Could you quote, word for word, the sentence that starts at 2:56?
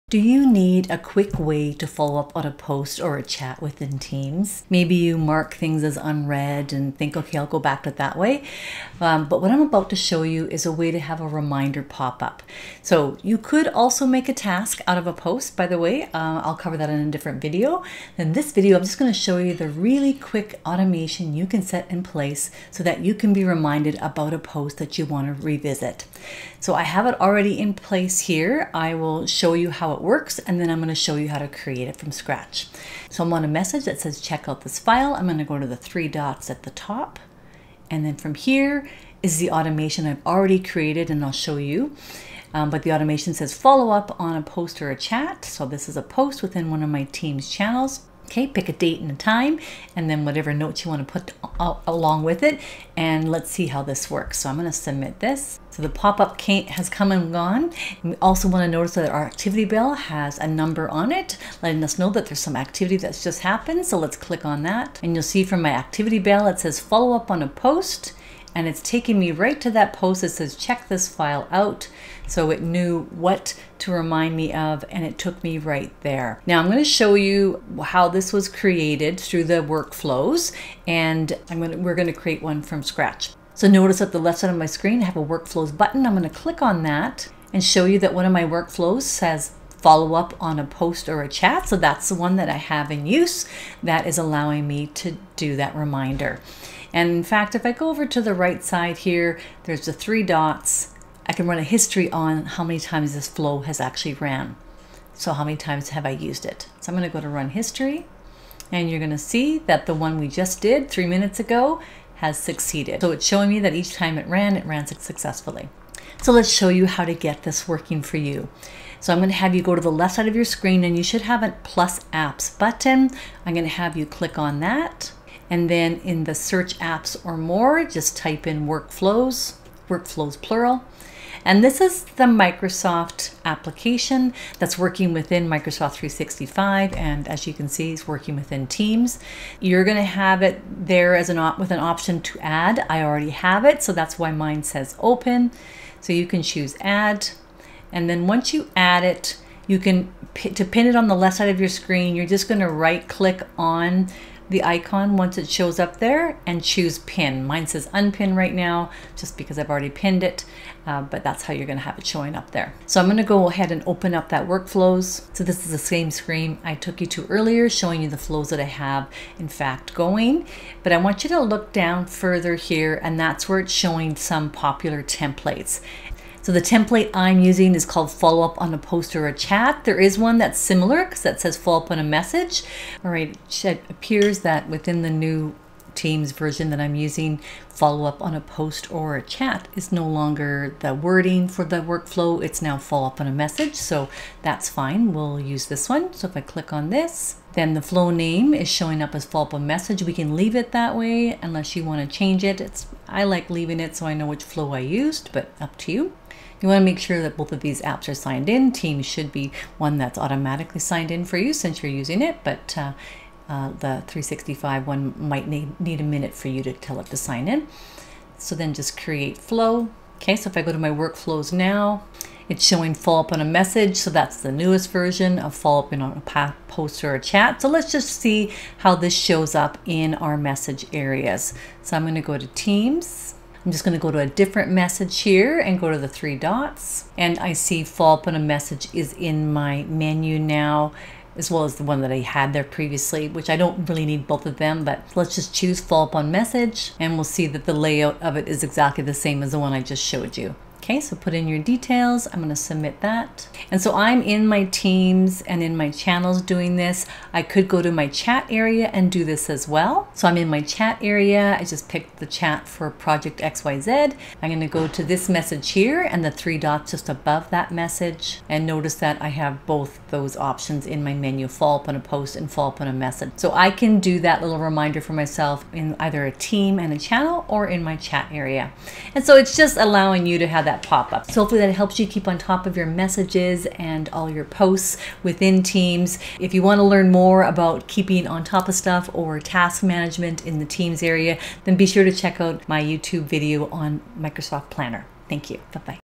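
So the template I'm using is called follow up on a post or a chat.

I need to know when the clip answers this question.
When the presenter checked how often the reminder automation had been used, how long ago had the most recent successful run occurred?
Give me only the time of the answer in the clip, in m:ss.
1:50.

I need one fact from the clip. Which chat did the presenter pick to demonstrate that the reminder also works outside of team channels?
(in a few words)
project XYZ.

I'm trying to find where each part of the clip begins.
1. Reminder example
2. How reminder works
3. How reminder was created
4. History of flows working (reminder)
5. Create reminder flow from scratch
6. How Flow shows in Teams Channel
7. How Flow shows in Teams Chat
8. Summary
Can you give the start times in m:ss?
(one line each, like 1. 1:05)
1. 0:20
2. 0:33
3. 1:16
4. 1:37
5. 1:55
6. 3:48
7. 4:17
8. 4:38.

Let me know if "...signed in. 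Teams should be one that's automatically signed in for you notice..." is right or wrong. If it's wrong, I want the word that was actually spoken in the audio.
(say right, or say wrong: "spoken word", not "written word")
wrong: "since", not "notice".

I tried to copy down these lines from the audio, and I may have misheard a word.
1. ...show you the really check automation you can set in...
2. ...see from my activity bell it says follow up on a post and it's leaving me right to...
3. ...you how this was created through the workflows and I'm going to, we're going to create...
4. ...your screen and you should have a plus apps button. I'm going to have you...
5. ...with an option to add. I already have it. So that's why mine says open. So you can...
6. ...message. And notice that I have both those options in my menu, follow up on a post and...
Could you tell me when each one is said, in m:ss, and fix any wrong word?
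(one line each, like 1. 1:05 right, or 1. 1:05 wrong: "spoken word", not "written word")
1. 0:19 wrong: "quick", not "check"
2. 1:05 wrong: "taking", not "leaving"
3. 1:17 right
4. 2:00 right
5. 2:21 right
6. 4:27 right.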